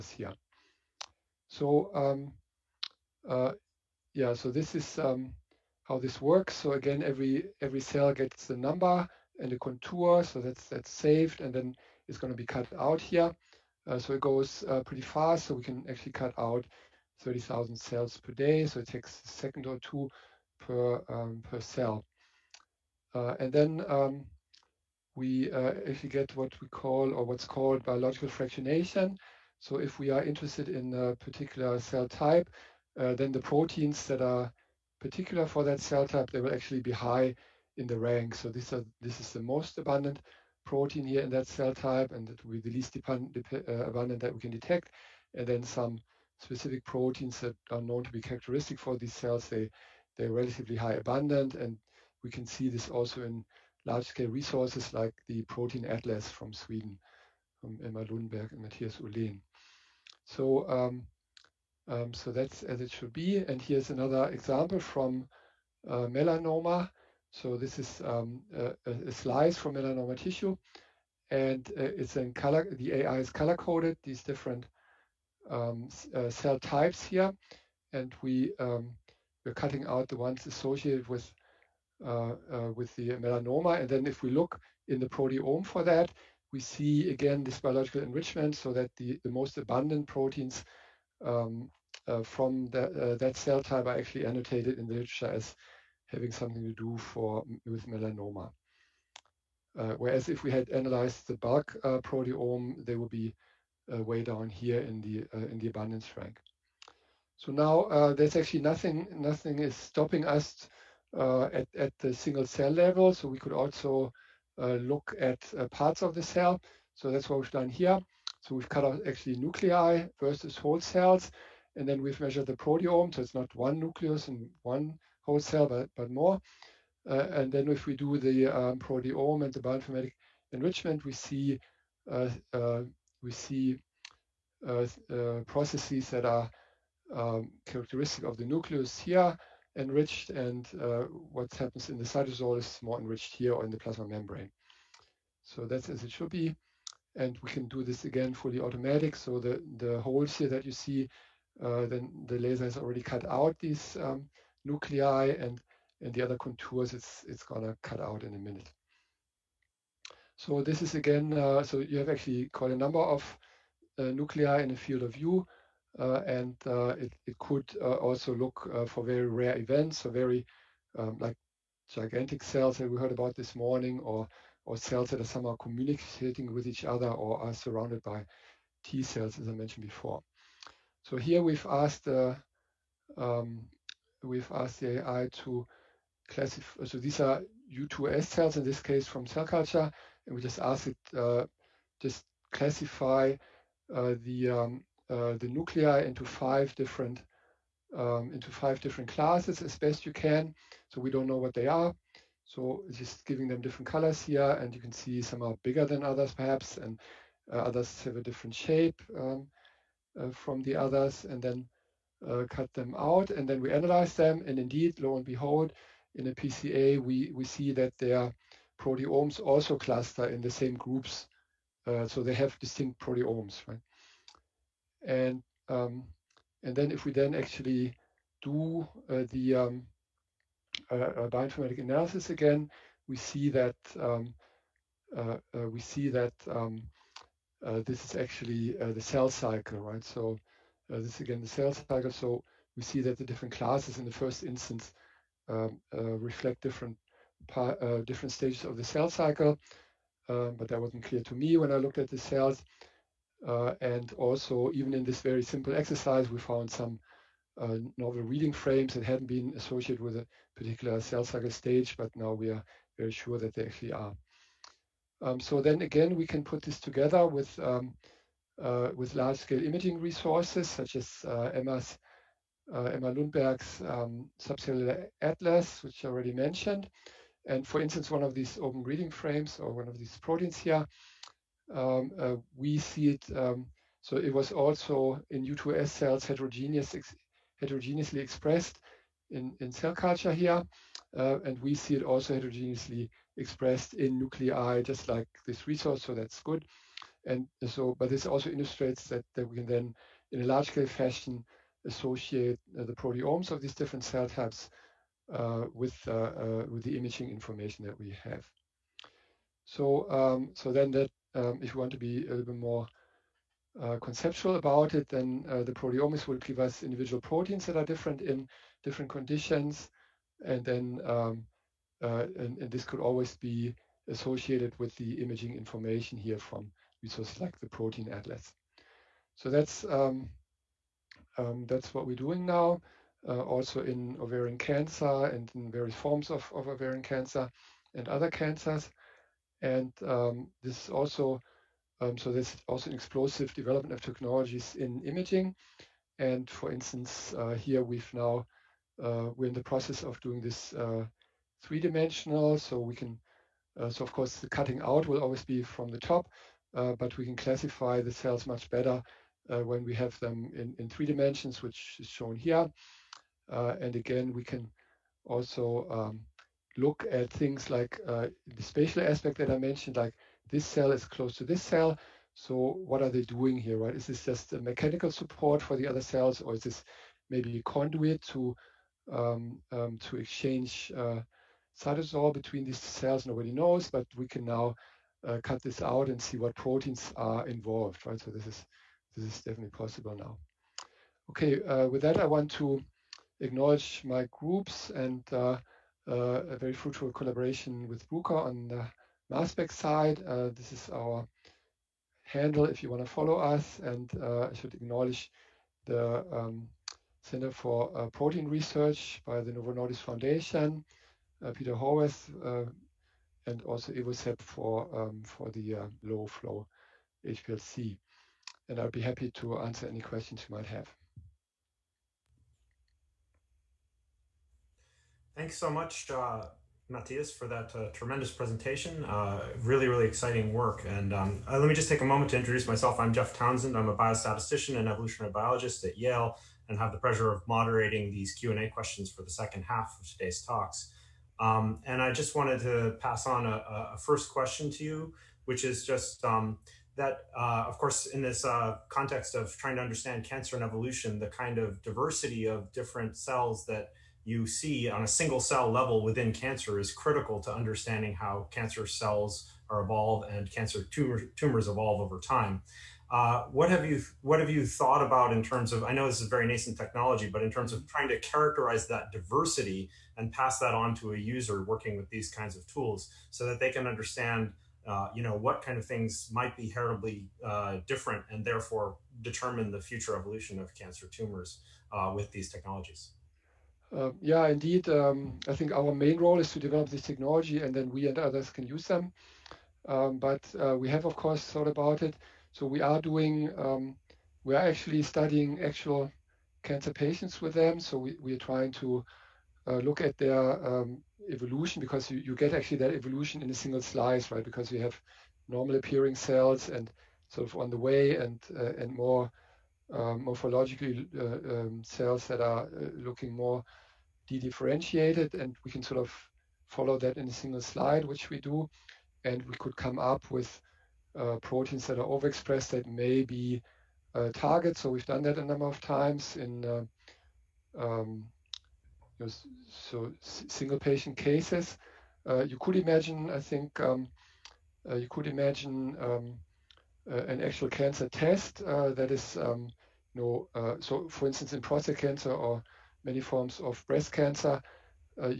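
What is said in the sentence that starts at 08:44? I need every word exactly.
So we've done that a number of times in um, so single patient cases.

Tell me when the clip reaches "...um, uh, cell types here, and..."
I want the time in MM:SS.
01:15.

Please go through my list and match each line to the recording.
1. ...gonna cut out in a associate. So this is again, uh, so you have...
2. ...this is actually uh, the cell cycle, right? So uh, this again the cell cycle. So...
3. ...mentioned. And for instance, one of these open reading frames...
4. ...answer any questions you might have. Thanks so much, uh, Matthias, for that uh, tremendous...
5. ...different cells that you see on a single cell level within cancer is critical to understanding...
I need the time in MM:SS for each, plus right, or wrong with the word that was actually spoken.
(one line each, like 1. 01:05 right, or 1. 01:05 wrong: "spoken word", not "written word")
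1. 02:37 wrong: "minute", not "associate"
2. 03:57 right
3. 04:36 right
4. 06:59 right
5. 07:32 right.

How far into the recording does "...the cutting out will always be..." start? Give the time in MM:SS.
05:54.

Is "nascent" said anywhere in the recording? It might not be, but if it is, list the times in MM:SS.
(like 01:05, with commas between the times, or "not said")
07:46.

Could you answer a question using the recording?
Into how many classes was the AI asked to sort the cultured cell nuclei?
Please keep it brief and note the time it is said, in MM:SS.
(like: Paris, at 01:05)
5, at 03:18.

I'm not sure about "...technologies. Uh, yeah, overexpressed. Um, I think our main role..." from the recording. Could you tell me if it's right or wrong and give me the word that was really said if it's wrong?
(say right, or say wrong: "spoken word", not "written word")
wrong: "indeed", not "overexpressed".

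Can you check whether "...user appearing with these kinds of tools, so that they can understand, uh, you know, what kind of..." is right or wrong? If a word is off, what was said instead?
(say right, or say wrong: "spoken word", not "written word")
wrong: "working", not "appearing".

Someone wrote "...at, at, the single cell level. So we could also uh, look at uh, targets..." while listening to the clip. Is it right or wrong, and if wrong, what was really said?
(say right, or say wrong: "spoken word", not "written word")
wrong: "parts", not "targets".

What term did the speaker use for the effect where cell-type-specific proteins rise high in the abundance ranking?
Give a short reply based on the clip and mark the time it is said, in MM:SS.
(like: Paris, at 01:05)
biological fractionation, at 00:27.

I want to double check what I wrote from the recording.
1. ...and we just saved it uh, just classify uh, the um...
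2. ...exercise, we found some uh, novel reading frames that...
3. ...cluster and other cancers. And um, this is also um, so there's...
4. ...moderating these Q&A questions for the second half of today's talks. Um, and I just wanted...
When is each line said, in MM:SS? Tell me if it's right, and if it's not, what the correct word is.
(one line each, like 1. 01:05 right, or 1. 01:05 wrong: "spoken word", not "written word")
1. 03:10 wrong: "asked", not "saved"
2. 04:15 right
3. 05:37 wrong: "cancer", not "cluster"
4. 07:17 right.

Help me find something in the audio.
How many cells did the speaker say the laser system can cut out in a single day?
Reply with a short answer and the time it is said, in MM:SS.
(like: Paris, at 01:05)
30,000, at 00:17.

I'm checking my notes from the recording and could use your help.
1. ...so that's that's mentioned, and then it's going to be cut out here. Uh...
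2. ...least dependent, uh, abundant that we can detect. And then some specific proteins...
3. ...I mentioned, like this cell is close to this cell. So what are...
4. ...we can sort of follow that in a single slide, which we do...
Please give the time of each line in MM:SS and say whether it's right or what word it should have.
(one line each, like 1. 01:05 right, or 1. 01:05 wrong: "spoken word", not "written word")
1. 00:10 wrong: "saved", not "mentioned"
2. 00:42 right
3. 06:09 right
4. 08:35 right.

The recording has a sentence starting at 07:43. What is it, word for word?
Uh, what have you What have you thought about in terms of?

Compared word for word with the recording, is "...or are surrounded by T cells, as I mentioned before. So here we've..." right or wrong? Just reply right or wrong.
right.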